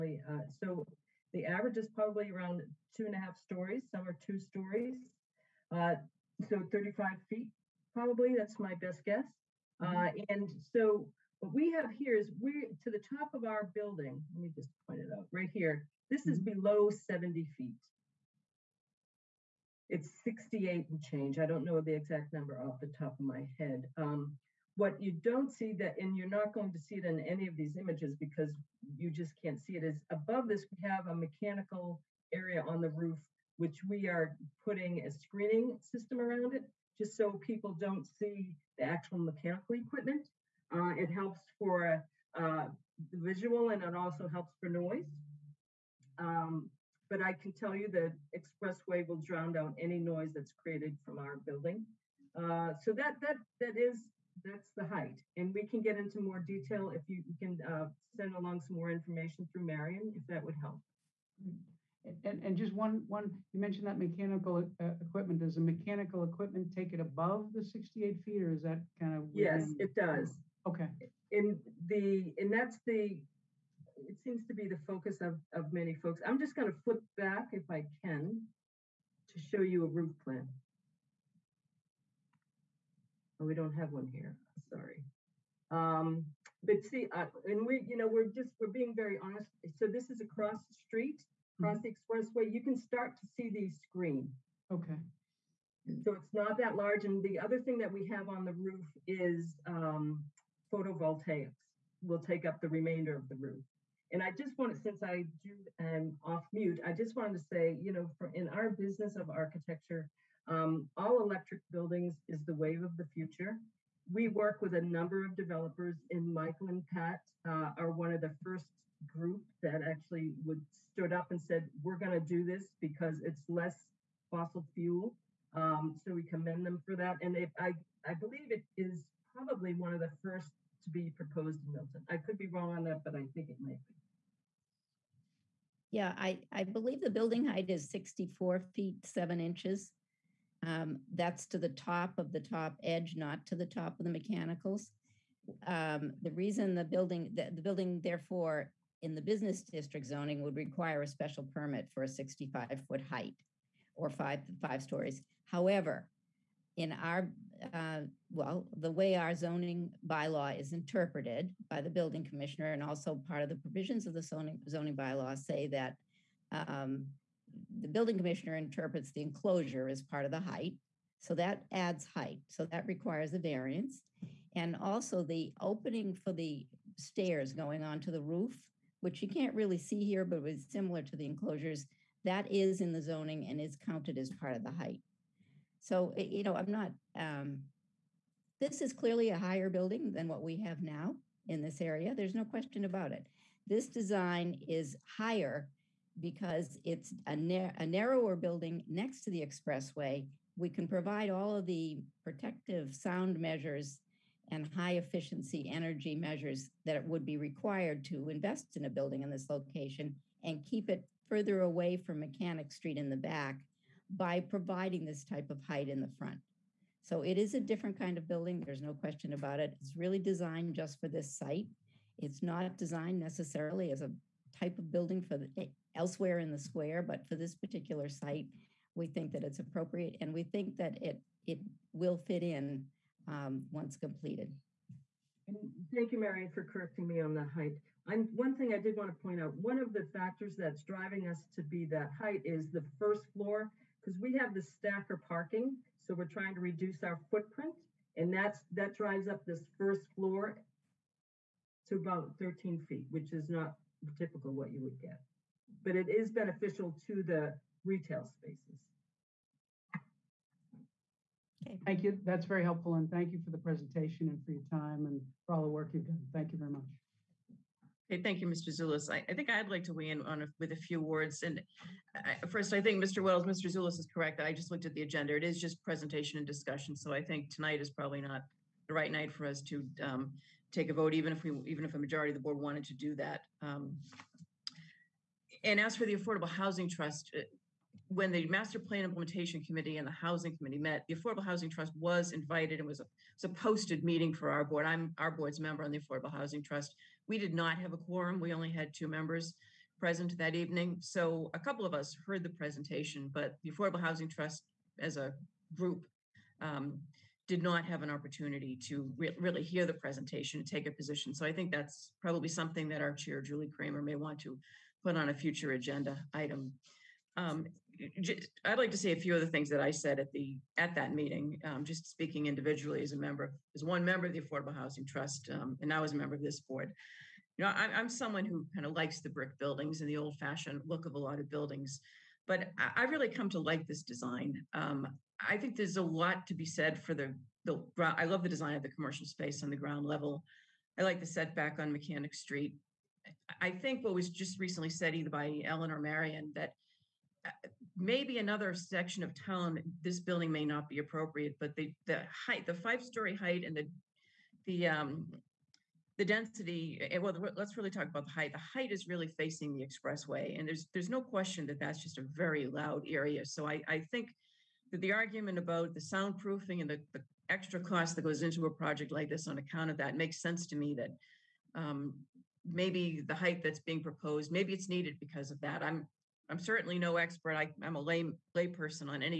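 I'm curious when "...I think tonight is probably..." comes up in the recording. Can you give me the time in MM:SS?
04:37.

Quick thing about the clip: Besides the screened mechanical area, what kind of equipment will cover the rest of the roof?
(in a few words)
Photovoltaics.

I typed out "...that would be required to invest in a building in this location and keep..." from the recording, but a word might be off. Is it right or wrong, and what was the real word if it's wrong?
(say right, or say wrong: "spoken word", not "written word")
right.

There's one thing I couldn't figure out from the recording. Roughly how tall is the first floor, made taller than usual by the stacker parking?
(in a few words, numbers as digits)
13 feet.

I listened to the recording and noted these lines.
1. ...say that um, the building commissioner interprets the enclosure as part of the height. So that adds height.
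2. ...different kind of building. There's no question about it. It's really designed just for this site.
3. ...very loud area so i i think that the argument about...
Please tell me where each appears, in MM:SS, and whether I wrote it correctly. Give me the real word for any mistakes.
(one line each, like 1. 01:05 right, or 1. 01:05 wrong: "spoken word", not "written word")
1. 02:45 right
2. 03:37 right
3. 06:02 right.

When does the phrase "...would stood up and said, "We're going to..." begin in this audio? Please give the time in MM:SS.
02:00.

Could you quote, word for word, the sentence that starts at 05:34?
Um, I think there's a lot to be said for the the.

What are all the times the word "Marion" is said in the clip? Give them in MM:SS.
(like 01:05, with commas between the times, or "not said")
00:59, 03:56, 05:45.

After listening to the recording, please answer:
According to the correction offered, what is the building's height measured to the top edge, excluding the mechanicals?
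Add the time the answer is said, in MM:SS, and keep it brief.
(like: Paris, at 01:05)
64 feet 7 inches, at 02:17.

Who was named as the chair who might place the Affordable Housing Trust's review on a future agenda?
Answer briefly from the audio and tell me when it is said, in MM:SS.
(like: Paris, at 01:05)
Julie Kramer, at 05:13.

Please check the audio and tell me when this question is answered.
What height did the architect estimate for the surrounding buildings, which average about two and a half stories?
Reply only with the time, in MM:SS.
00:06.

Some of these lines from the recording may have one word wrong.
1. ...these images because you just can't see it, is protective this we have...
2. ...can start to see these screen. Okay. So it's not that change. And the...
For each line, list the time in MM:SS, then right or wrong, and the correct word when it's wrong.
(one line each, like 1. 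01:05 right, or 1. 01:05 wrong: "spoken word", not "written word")
1. 00:27 wrong: "above", not "protective"
2. 01:32 wrong: "large", not "change".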